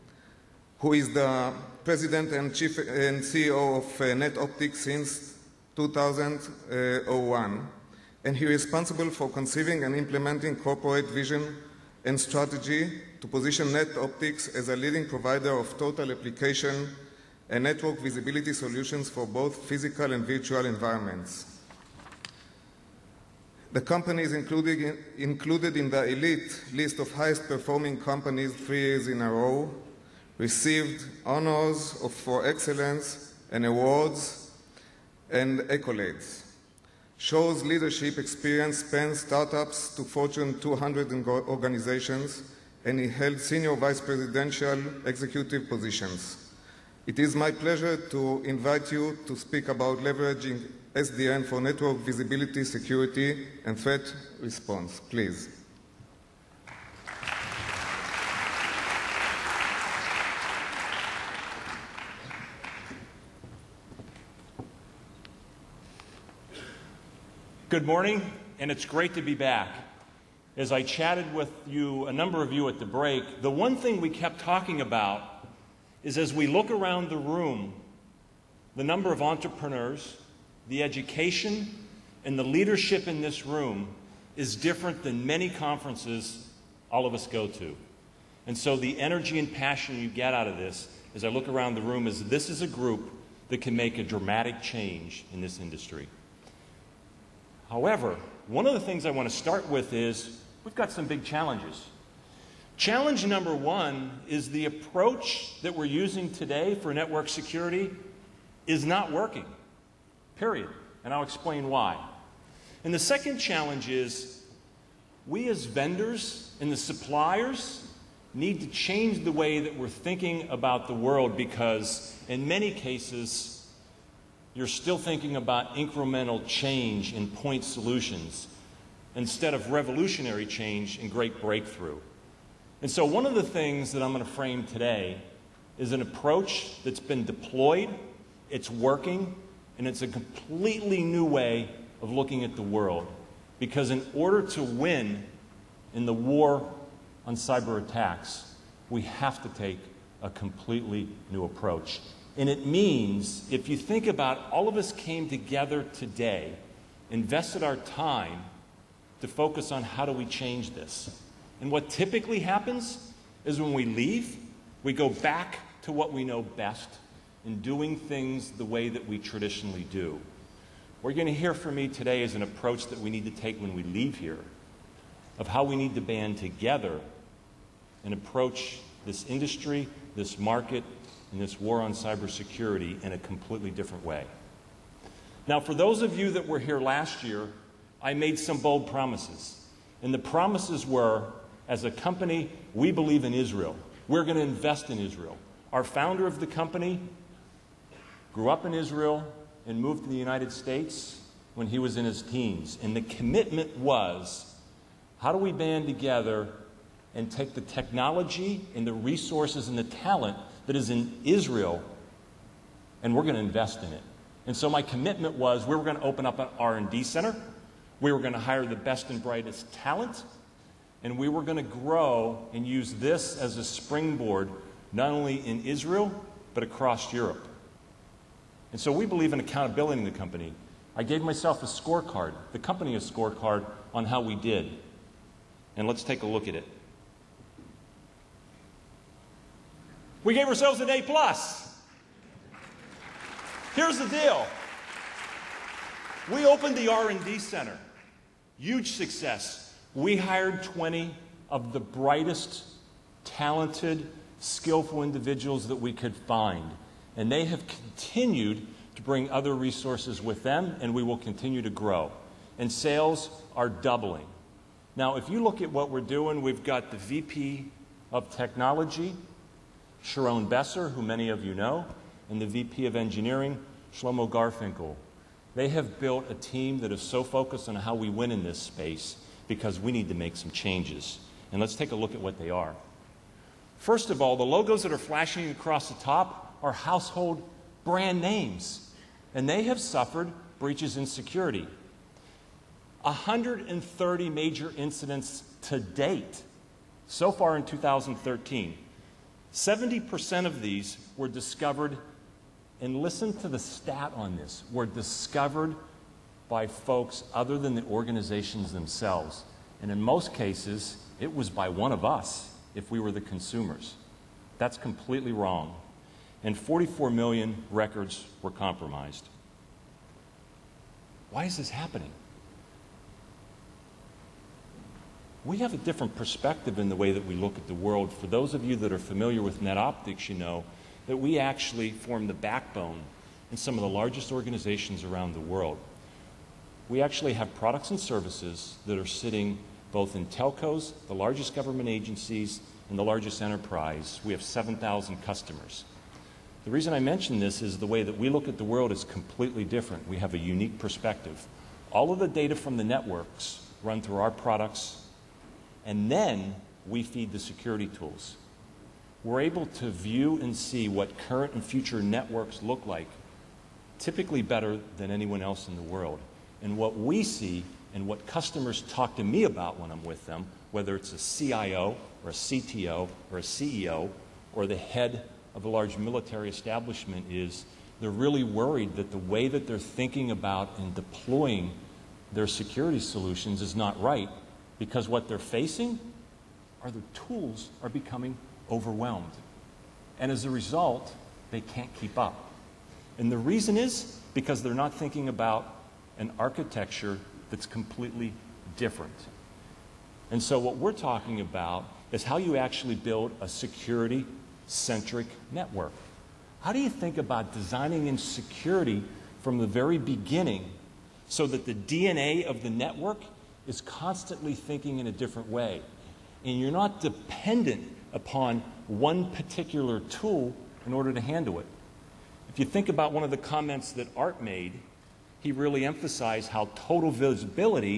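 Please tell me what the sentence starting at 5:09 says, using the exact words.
And in most cases, it was by one of us if we were the consumers.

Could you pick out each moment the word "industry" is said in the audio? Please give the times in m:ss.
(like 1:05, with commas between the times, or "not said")
1:35, 2:59.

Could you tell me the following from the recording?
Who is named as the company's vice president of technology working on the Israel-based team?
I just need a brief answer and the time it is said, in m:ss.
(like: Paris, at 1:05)
Sharon Besser, at 4:30.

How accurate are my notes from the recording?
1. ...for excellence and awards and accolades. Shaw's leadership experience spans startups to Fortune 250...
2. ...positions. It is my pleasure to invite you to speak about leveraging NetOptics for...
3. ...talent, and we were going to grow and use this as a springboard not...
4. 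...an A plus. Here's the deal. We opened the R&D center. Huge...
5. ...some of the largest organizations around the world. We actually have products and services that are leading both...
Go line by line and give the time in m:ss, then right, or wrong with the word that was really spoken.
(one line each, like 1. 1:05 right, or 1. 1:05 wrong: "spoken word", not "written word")
1. 0:32 wrong: "200", not "250"
2. 0:45 wrong: "SDN", not "NetOptics"
3. 3:39 right
4. 4:00 right
5. 5:33 wrong: "sitting", not "leading".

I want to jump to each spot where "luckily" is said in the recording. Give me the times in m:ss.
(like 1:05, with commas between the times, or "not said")
not said.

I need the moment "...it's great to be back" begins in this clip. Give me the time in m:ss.
1:08.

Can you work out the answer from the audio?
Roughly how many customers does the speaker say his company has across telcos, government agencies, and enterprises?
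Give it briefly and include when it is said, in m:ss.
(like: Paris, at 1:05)
7,000, at 5:44.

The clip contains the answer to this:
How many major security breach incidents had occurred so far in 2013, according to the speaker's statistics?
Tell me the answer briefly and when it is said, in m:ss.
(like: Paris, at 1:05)
130, at 4:53.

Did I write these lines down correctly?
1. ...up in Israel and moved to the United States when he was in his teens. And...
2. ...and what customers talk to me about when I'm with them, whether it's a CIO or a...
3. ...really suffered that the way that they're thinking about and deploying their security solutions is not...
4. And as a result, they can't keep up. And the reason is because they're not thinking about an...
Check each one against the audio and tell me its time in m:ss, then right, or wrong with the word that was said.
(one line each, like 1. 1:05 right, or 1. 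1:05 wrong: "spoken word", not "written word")
1. 3:18 right
2. 6:07 right
3. 6:18 wrong: "worried", not "suffered"
4. 6:30 right.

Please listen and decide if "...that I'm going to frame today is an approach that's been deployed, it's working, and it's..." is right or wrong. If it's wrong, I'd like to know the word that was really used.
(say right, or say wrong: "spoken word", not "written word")
right.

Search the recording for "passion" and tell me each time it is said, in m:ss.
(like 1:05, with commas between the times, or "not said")
1:29.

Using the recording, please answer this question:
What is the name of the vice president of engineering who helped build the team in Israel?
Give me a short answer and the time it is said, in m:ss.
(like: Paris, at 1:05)
Shlomo Garfinkel, at 4:33.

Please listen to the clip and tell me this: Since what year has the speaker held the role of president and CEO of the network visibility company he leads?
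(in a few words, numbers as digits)
2001.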